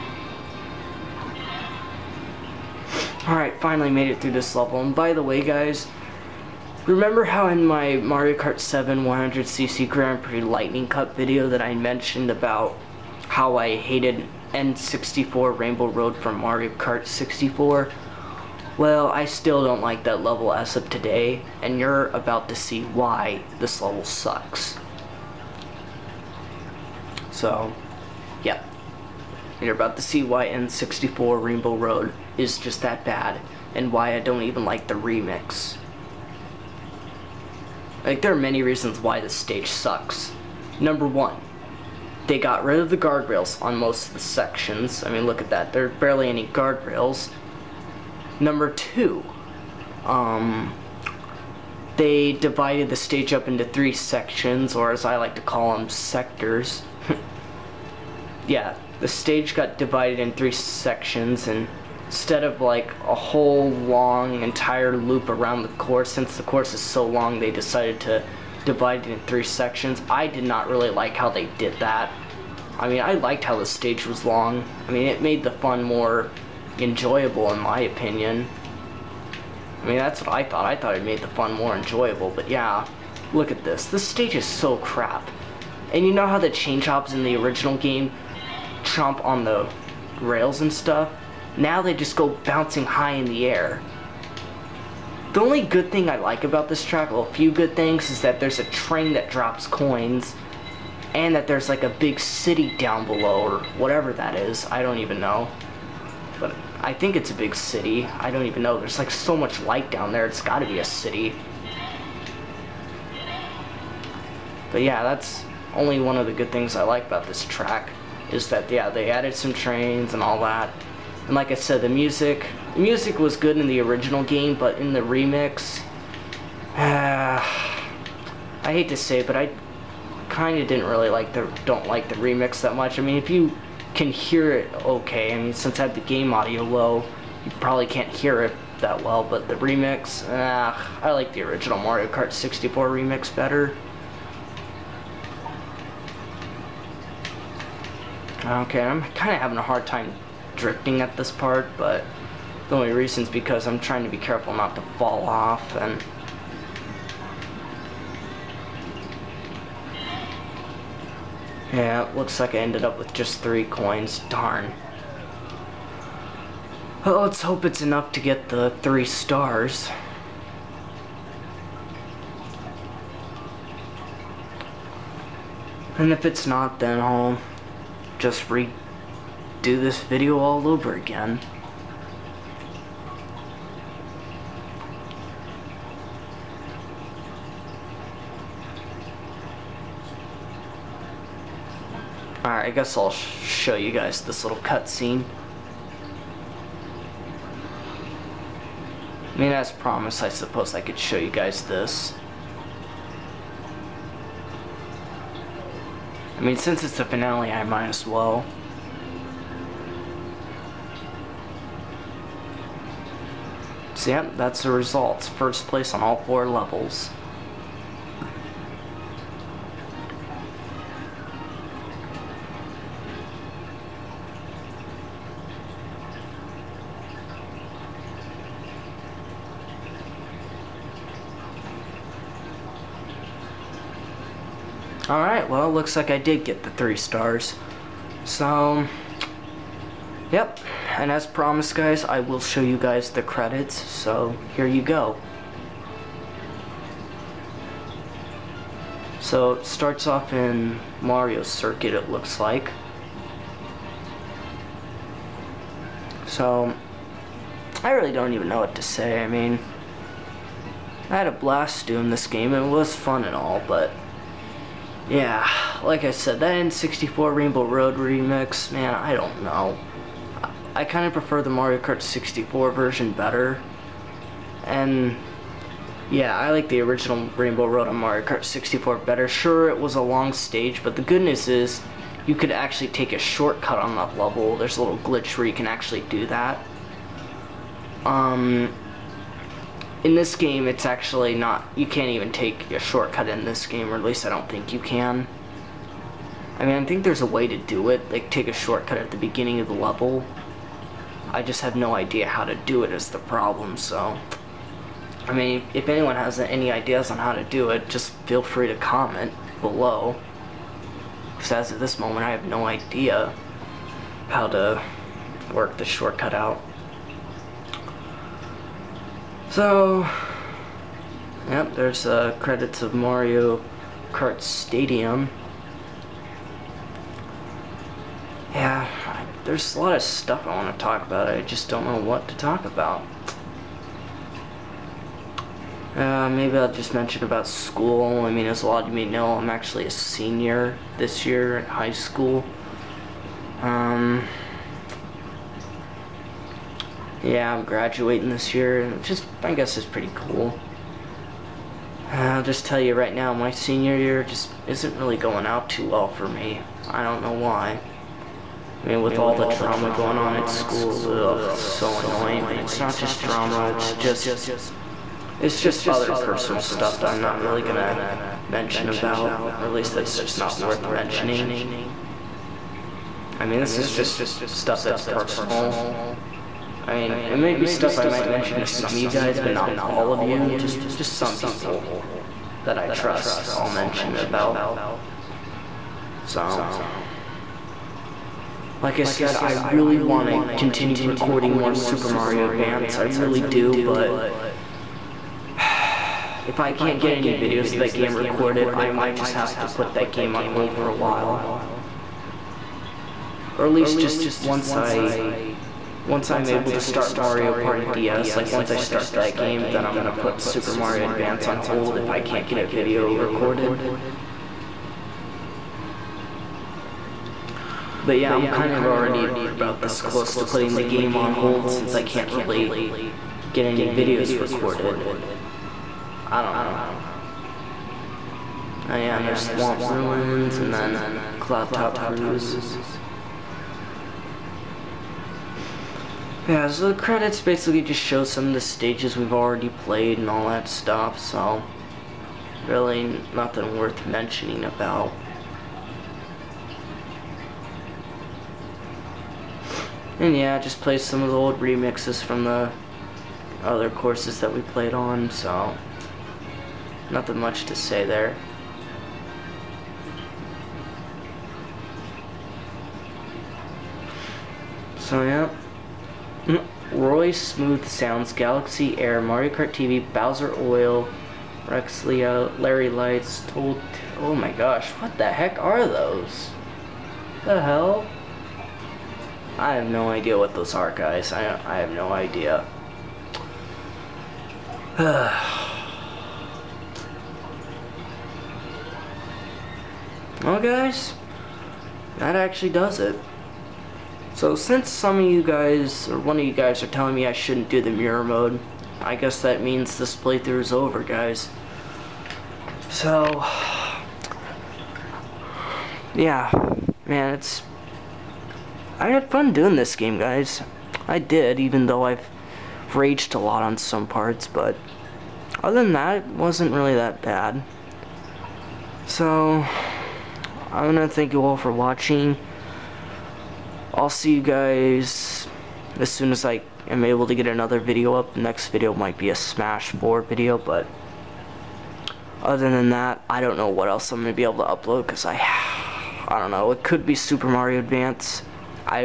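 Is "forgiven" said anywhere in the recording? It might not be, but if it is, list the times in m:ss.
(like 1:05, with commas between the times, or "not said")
not said.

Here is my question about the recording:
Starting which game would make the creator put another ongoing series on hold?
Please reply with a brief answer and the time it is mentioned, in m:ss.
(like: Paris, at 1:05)
Mario Party DS, at 6:47.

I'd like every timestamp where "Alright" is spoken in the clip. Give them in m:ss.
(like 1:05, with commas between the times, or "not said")
0:03, 3:12.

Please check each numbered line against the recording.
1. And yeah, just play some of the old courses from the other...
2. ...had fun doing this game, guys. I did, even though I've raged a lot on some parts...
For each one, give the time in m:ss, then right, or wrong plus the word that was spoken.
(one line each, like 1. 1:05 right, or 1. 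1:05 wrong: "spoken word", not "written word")
1. 7:30 wrong: "remixes", not "courses"
2. 8:29 right.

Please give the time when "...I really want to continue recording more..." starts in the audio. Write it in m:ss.
6:29.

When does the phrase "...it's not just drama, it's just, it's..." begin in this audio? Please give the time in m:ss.
6:02.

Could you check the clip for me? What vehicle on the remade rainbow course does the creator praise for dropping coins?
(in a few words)
A train.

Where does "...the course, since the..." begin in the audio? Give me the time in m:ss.
1:05.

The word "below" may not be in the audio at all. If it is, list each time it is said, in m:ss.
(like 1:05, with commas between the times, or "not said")
1:43, 5:09.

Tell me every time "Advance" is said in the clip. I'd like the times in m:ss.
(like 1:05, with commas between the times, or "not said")
6:32, 6:51, 8:57.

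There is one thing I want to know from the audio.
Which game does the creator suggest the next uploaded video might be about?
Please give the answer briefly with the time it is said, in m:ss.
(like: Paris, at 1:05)
Smash 4, at 8:49.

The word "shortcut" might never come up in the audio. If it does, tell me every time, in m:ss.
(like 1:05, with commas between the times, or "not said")
4:43, 4:52, 4:58, 5:15.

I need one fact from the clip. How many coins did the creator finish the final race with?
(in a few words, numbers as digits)
3.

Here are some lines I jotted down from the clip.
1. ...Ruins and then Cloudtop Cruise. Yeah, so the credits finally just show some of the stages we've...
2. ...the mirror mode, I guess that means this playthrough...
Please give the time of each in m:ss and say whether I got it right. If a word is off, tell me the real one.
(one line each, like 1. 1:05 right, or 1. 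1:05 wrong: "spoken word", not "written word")
1. 7:09 wrong: "basically", not "finally"
2. 8:17 right.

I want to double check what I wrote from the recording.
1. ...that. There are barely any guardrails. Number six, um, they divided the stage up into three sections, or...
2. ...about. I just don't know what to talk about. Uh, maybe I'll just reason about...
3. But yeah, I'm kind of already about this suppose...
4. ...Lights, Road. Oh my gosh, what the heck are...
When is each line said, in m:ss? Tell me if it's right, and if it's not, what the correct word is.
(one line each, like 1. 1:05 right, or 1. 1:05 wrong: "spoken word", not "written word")
1. 0:45 wrong: "two", not "six"
2. 5:31 wrong: "mention", not "reason"
3. 6:58 wrong: "close", not "suppose"
4. 7:52 wrong: "Told", not "Road".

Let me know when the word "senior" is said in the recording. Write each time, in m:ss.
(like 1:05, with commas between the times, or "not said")
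5:39, 5:53.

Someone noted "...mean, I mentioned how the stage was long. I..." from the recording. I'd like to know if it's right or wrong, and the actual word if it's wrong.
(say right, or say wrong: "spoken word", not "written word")
wrong: "liked", not "mentioned".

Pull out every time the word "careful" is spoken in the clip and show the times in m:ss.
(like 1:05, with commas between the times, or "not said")
2:34.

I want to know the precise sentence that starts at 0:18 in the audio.
Well, I still don't like that level as of today, and you're about to see why this level sucks.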